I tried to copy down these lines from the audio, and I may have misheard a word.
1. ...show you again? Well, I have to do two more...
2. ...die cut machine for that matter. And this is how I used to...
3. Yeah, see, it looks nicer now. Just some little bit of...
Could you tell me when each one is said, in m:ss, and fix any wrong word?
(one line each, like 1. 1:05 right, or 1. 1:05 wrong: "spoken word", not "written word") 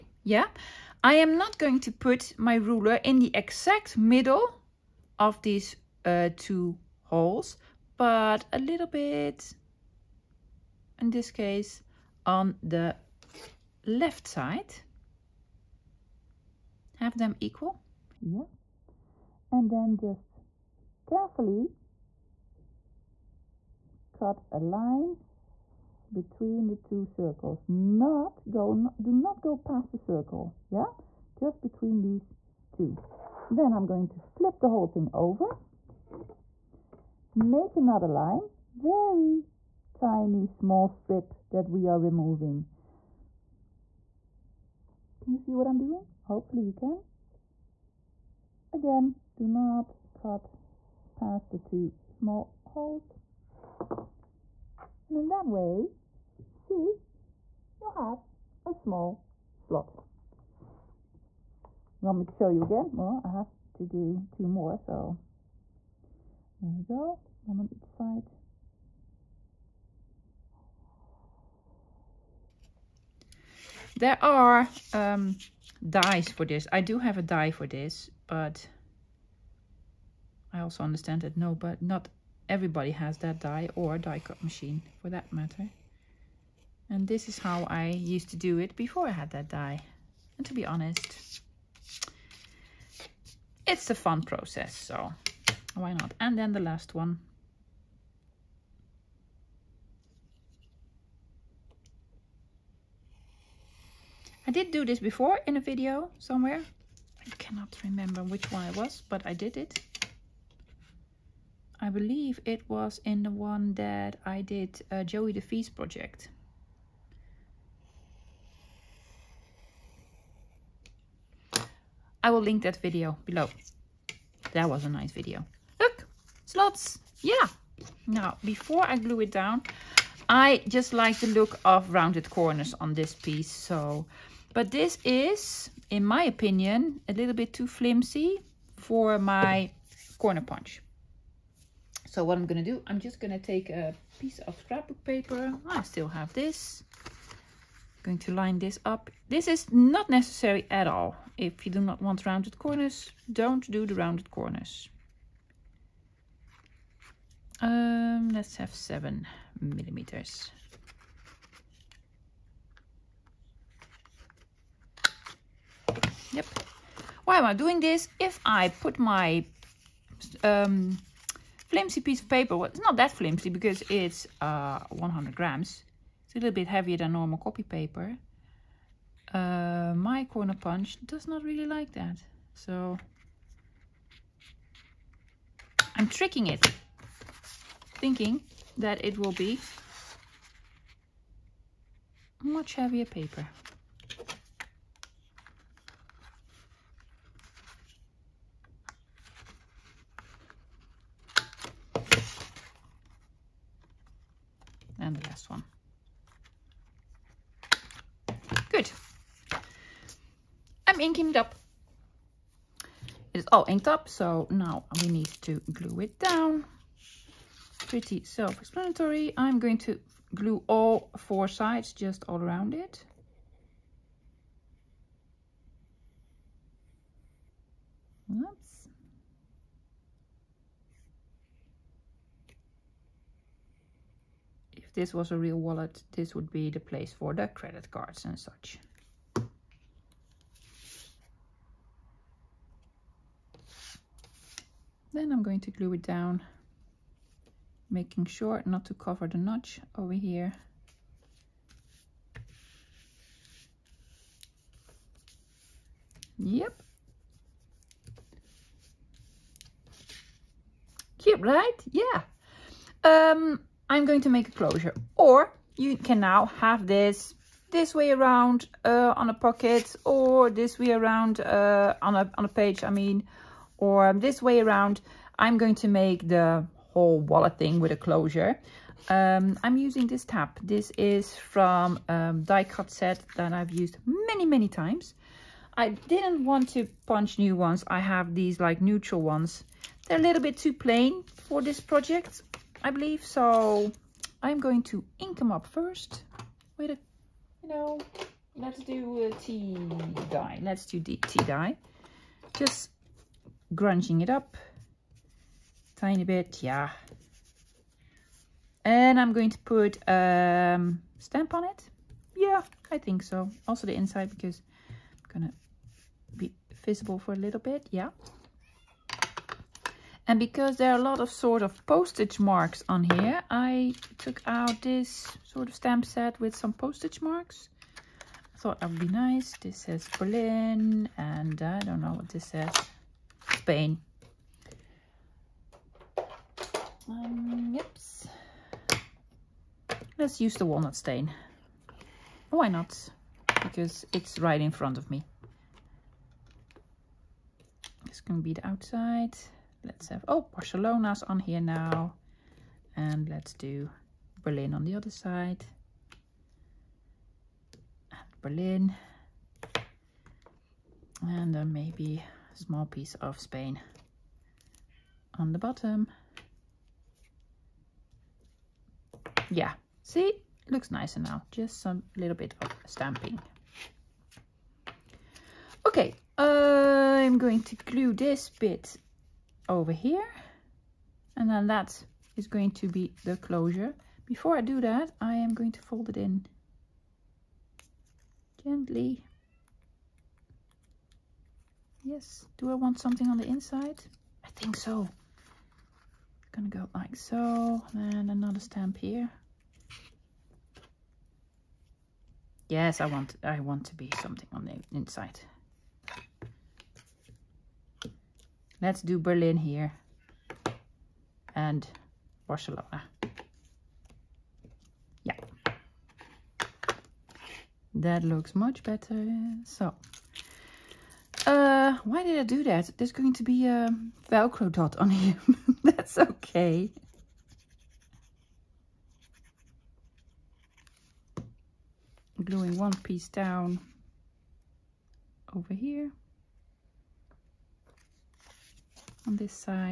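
1. 1:02 right
2. 1:23 right
3. 6:09 right.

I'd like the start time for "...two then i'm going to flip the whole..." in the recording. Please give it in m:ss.
0:32.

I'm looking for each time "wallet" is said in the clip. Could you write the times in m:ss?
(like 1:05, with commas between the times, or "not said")
3:55, 4:37.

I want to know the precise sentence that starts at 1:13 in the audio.
There are um, dies for this.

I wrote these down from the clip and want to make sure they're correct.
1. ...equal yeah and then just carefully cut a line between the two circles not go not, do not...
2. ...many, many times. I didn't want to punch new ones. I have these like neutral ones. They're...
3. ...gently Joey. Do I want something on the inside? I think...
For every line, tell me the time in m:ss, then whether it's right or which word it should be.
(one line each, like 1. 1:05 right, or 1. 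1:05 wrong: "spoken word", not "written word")
1. 0:17 right
2. 4:44 right
3. 6:28 wrong: "Yes", not "Joey".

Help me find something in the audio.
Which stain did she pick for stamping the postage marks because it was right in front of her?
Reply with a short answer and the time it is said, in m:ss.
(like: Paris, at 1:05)
walnut stain, at 5:40.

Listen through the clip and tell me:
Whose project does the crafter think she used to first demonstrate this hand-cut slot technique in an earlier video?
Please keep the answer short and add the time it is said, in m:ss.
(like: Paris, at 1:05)
Joey DeVee, at 1:55.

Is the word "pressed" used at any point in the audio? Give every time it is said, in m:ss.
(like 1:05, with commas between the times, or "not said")
not said.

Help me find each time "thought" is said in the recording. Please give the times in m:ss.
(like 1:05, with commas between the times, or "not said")
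5:28.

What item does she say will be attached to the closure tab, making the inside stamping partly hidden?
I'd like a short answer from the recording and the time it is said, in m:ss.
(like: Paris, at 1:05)
Velcro dot, at 7:04.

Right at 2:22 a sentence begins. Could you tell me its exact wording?
So what I'm going to do, I'm just going to take a piece of scrapbook paper.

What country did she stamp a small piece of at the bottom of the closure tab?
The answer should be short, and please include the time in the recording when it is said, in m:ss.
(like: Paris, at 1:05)
Spain, at 6:03.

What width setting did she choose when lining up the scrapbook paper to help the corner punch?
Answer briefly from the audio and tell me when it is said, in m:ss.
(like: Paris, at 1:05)
7 millimeters, at 2:38.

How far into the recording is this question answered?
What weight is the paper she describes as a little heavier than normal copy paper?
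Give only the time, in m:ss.
2:54.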